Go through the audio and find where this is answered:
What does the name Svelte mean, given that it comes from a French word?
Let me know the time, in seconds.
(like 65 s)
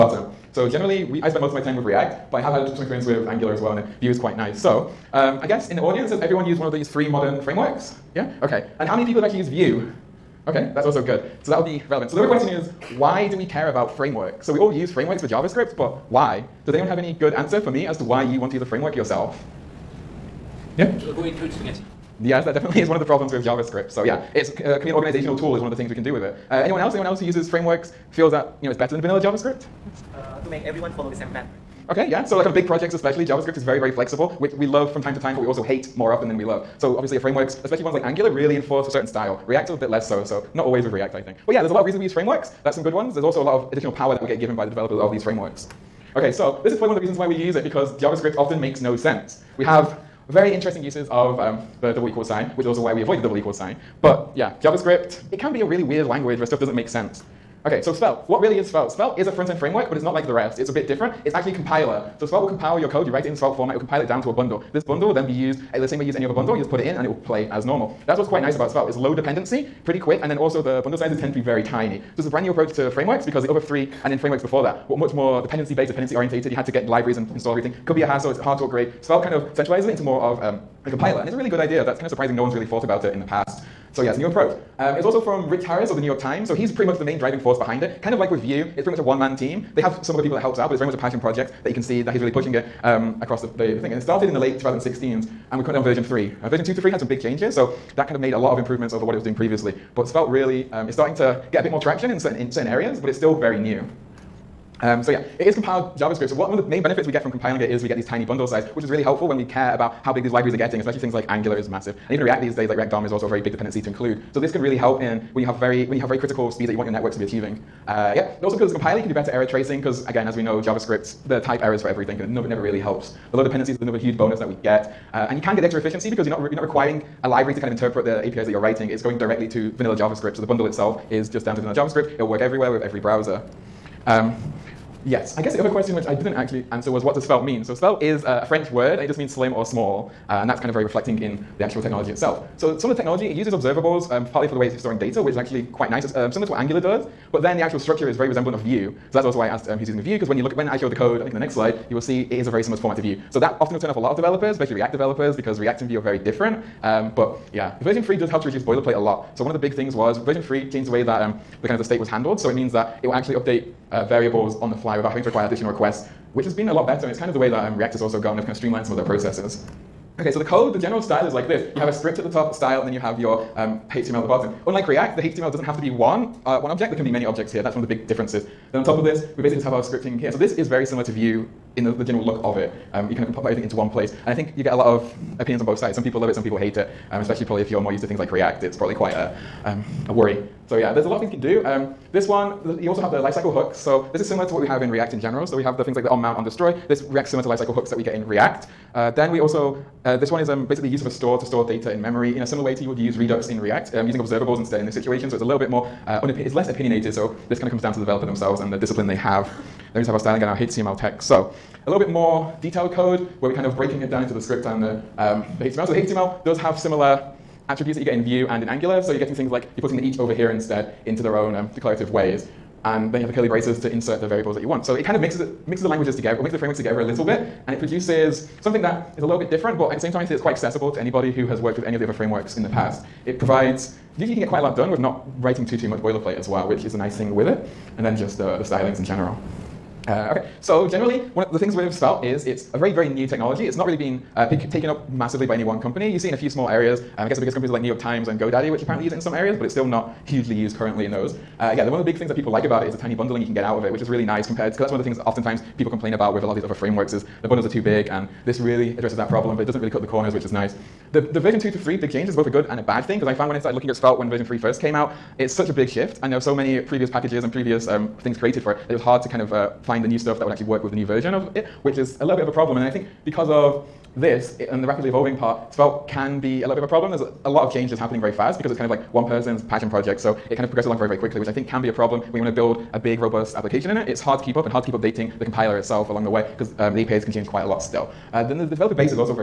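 139 s.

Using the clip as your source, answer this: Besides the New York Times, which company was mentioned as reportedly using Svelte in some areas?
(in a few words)
GoDaddy.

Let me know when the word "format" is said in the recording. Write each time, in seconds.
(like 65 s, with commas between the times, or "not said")
63 s, 152 s.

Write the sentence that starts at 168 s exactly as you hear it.
They've kind of streamlined some of their processes.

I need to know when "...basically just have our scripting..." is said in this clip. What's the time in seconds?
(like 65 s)
179 s.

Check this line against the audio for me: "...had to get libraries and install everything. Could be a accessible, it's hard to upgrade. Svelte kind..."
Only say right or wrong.
wrong.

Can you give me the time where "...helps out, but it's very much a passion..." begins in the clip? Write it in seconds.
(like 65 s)
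90 s.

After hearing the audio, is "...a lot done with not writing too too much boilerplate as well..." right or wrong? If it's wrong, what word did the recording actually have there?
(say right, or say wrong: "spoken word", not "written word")
right.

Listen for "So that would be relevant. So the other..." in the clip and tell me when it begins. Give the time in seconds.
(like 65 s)
11 s.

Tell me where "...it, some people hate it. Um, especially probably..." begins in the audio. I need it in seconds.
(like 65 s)
186 s.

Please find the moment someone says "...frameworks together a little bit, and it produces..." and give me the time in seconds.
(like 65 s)
226 s.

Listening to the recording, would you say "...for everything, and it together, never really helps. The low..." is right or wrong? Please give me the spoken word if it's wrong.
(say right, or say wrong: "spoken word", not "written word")
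wrong: "never", not "together".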